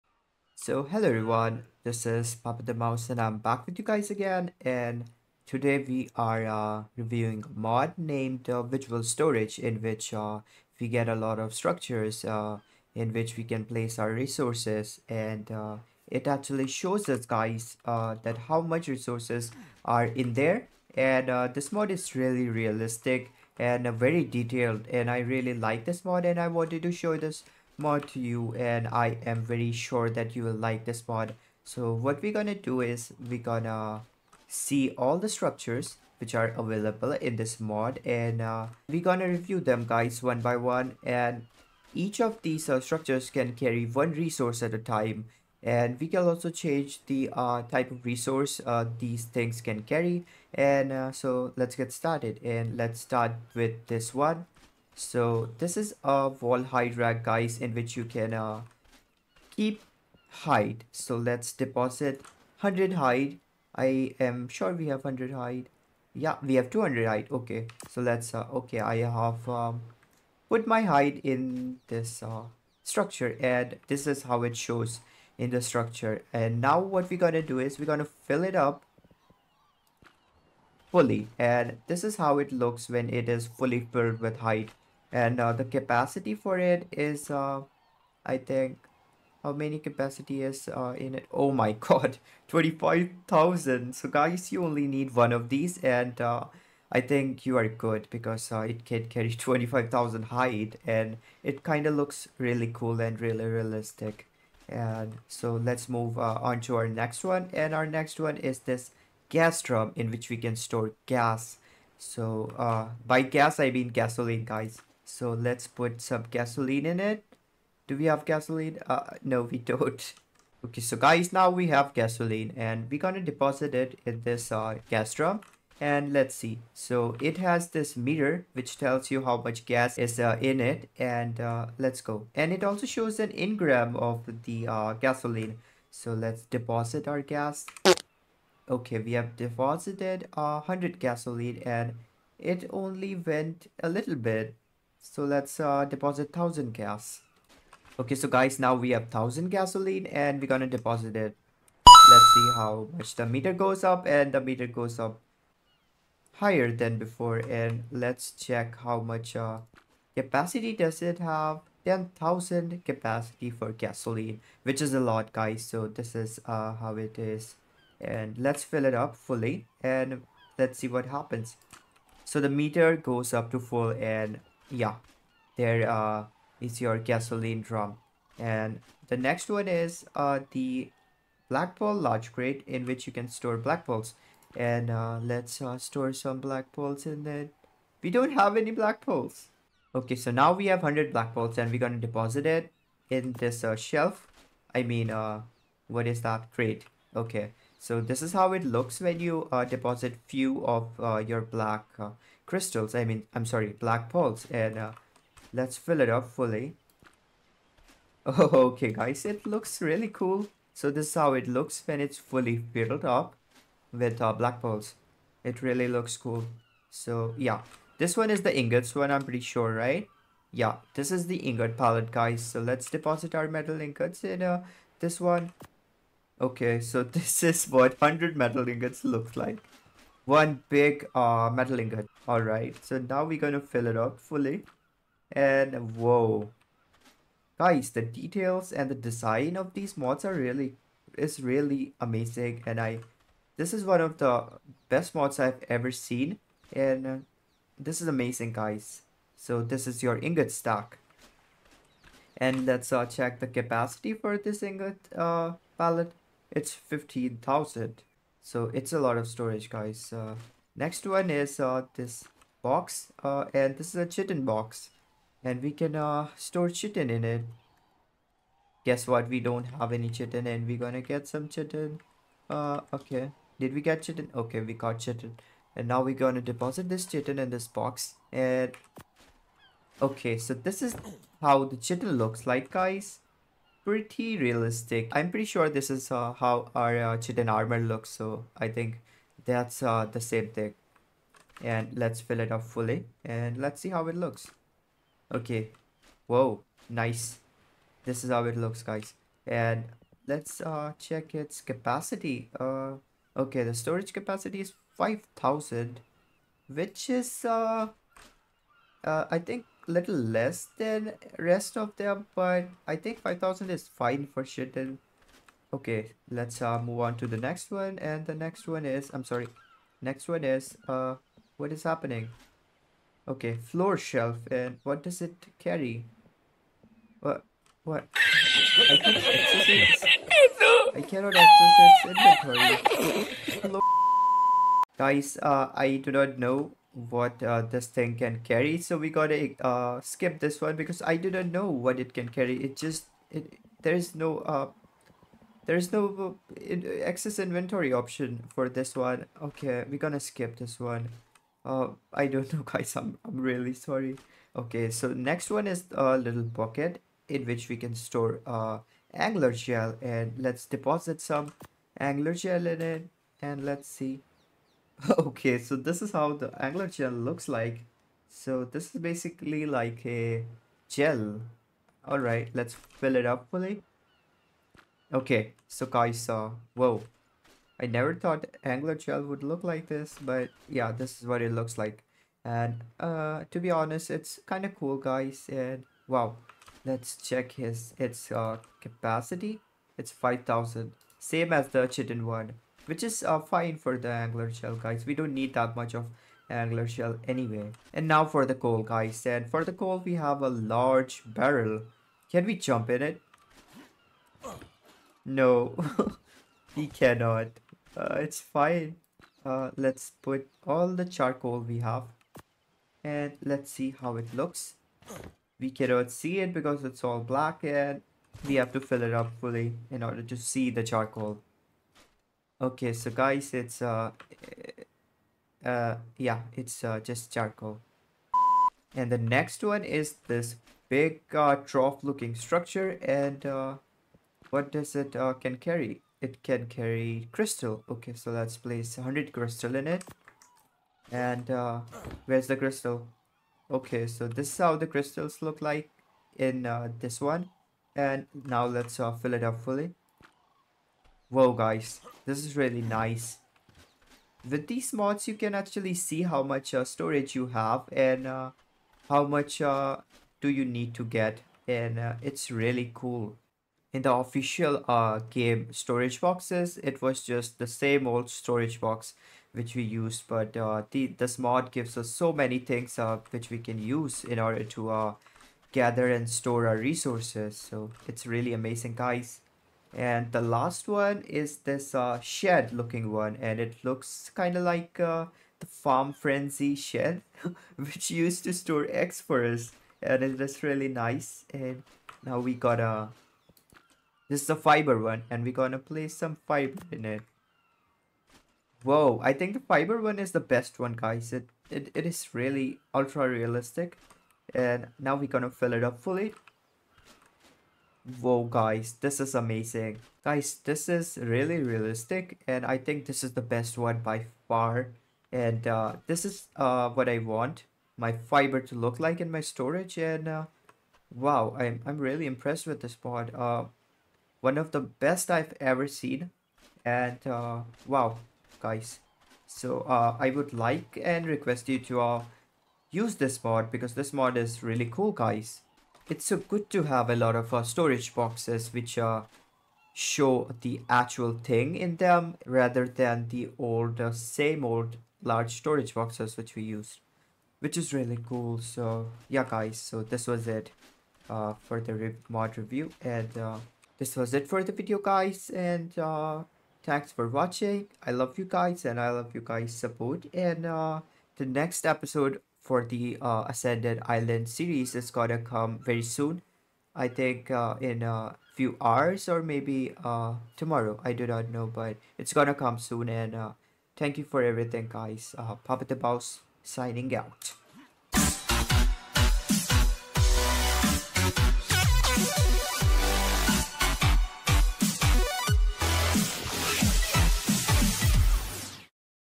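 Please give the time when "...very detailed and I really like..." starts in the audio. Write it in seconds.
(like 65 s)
23 s.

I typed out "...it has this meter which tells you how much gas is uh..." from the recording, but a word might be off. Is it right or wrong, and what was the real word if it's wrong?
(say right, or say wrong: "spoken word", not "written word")
right.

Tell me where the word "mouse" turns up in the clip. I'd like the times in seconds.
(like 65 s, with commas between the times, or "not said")
2 s, 576 s.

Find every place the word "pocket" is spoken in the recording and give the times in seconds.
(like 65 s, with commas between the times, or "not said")
356 s.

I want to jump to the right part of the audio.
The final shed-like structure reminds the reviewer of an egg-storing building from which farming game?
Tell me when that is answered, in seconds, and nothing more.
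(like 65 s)
485 s.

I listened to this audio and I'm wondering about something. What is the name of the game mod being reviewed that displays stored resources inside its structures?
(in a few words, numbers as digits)
Visual Storage.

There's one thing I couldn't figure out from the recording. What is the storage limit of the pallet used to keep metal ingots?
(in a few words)
15,000.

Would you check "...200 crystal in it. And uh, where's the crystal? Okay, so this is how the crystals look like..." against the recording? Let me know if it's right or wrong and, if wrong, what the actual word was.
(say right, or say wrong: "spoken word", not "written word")
wrong: "100", not "200".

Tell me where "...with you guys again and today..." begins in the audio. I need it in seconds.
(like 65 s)
3 s.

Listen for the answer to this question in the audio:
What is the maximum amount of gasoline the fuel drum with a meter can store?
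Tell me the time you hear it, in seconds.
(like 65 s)
161 s.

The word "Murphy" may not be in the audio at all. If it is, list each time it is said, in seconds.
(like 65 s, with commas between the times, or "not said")
not said.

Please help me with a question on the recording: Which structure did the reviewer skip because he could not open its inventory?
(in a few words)
floor shelf.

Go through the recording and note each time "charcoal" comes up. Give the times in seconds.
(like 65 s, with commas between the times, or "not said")
411 s, 420 s, 427 s.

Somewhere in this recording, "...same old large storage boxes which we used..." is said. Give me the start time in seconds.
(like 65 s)
544 s.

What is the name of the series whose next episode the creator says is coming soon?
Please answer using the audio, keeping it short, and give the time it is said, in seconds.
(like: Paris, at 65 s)
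Ascended Island, at 563 s.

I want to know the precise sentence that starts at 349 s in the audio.
Okay, we're gonna skip this one.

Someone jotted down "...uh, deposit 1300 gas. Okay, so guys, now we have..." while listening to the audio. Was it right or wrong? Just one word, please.
wrong.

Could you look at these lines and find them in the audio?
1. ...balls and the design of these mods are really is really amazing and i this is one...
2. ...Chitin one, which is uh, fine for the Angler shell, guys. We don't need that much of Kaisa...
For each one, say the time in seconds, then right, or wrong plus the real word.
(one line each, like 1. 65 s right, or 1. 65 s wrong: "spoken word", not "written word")
1. 238 s wrong: "details", not "balls"
2. 391 s wrong: "Angler", not "Kaisa".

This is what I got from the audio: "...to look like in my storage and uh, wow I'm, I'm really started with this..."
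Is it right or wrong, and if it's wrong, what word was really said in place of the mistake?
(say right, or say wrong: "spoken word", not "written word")
wrong: "impressed", not "started".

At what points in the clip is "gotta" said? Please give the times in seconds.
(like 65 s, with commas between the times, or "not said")
339 s.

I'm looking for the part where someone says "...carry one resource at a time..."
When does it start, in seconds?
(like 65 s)
43 s.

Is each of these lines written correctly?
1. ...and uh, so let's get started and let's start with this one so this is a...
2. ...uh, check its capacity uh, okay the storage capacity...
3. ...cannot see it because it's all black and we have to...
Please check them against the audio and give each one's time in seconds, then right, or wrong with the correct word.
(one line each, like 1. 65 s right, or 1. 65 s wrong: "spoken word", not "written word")
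1. 50 s right
2. 300 s right
3. 415 s right.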